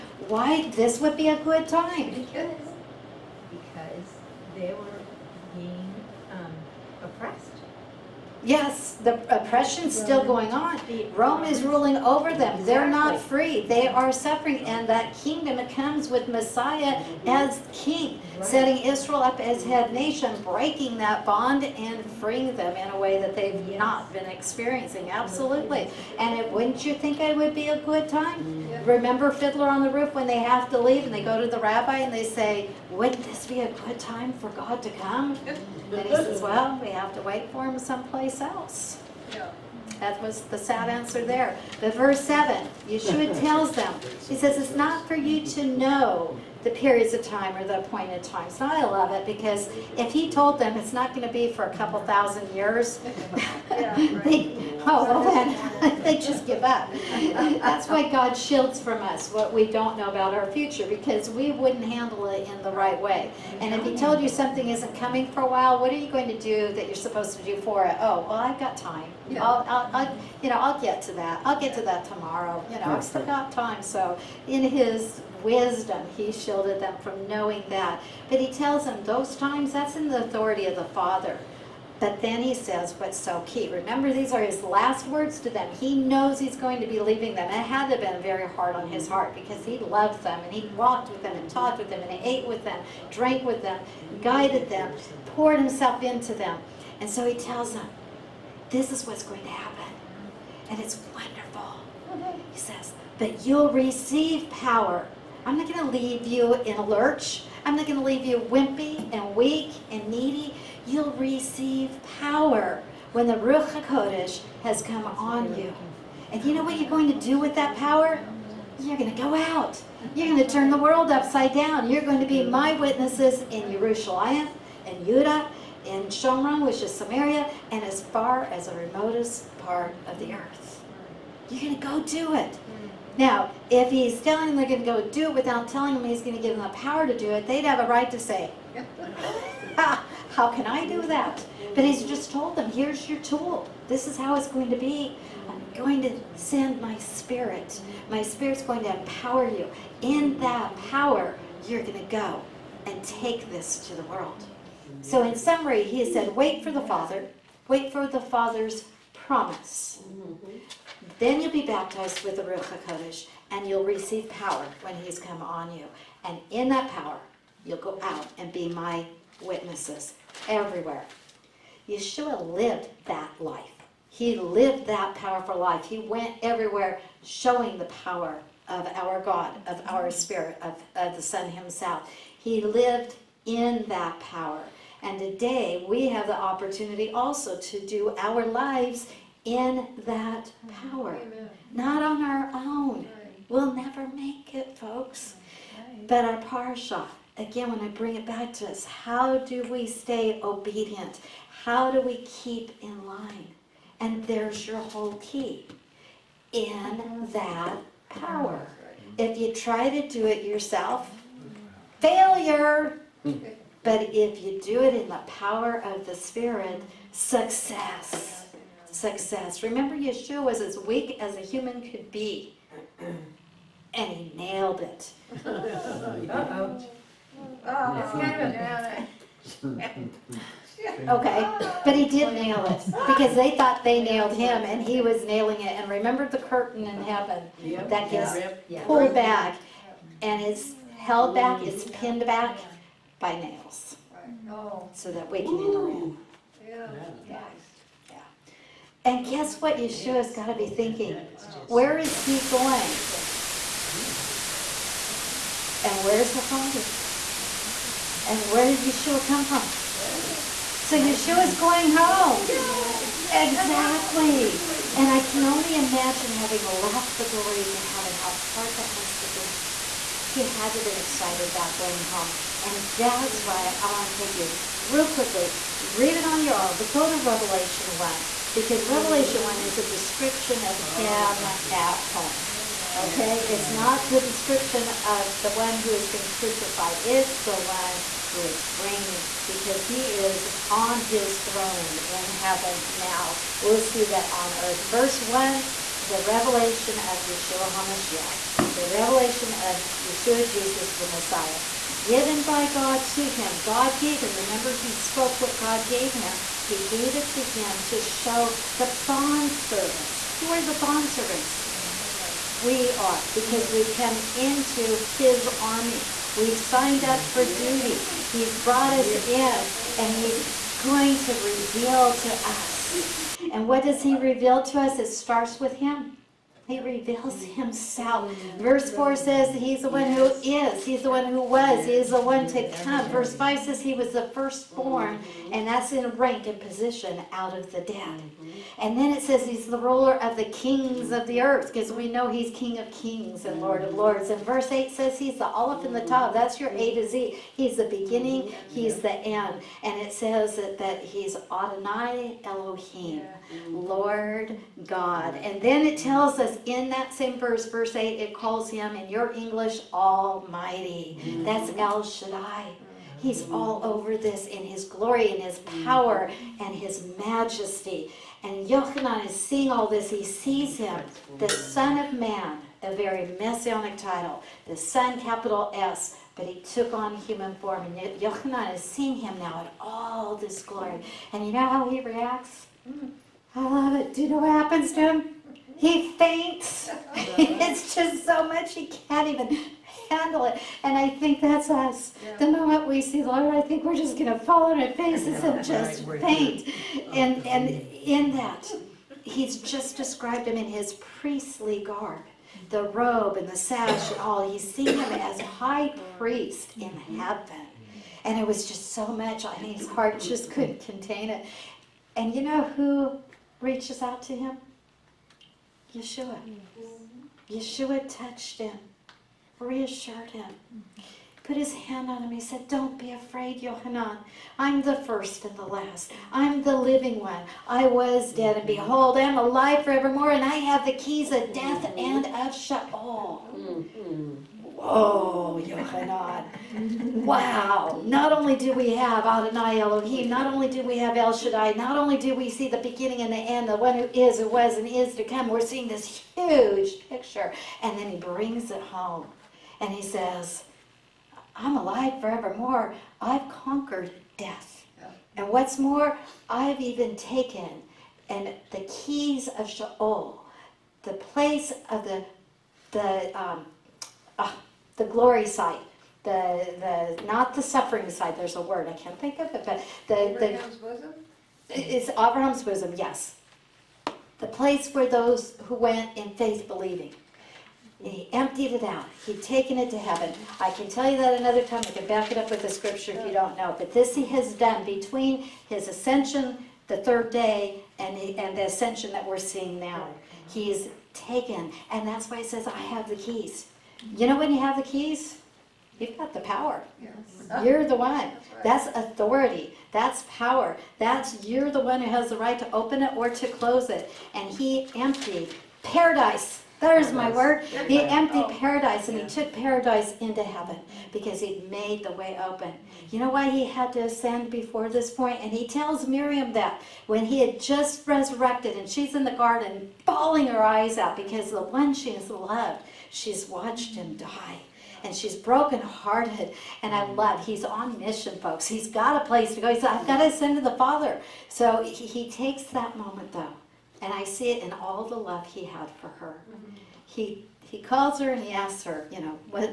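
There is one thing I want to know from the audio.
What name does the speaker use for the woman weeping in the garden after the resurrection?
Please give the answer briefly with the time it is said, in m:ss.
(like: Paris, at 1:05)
Miriam, at 8:36.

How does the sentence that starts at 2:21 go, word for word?
But he's just told them, here's your tool.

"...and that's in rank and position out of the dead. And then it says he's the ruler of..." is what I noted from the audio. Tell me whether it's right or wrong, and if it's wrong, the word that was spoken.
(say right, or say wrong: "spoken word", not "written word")
right.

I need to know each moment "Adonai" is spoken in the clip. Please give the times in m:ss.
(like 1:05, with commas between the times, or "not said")
5:51, 7:19.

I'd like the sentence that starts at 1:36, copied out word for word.
And so he tells them, this is what's going to happen.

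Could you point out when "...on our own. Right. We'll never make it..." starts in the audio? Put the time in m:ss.
3:12.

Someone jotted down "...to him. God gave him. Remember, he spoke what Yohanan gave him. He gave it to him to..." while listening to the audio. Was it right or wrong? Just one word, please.
wrong.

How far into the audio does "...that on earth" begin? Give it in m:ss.
4:54.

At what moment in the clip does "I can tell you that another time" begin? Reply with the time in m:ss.
8:00.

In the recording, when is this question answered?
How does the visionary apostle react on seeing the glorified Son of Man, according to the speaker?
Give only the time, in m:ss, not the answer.
6:25.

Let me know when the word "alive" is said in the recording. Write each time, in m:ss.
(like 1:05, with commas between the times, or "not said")
7:09, 7:31.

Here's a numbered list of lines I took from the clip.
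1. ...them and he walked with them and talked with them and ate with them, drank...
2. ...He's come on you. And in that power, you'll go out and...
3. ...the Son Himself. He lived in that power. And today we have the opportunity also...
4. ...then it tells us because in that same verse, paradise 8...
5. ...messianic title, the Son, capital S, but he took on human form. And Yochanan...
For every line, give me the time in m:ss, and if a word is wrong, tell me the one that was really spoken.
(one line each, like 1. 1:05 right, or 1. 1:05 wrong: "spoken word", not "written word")
1. 1:30 right
2. 2:44 right
3. 3:01 right
4. 5:55 wrong: "verse", not "paradise"
5. 6:13 right.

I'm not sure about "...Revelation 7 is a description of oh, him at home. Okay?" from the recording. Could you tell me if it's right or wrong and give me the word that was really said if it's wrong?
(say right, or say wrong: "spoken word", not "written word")
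wrong: "1", not "7".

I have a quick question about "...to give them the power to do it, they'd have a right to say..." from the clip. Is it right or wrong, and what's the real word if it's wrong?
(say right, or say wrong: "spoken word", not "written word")
right.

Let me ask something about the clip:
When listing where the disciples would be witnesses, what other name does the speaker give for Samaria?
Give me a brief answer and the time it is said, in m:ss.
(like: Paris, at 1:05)
Shomron, at 2:06.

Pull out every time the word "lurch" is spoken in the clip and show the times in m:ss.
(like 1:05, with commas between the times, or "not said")
1:46.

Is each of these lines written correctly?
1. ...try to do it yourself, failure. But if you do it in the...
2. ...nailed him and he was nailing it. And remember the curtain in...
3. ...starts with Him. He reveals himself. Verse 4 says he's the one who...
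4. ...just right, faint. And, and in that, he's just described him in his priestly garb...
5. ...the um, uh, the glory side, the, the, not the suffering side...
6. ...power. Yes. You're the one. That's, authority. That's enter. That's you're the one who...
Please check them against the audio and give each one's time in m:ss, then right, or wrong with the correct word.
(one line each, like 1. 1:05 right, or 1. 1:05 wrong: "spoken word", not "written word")
1. 3:29 right
2. 3:54 right
3. 5:25 right
4. 6:35 right
5. 7:42 right
6. 8:16 wrong: "power", not "enter".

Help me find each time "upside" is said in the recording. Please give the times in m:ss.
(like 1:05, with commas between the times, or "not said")
2:01.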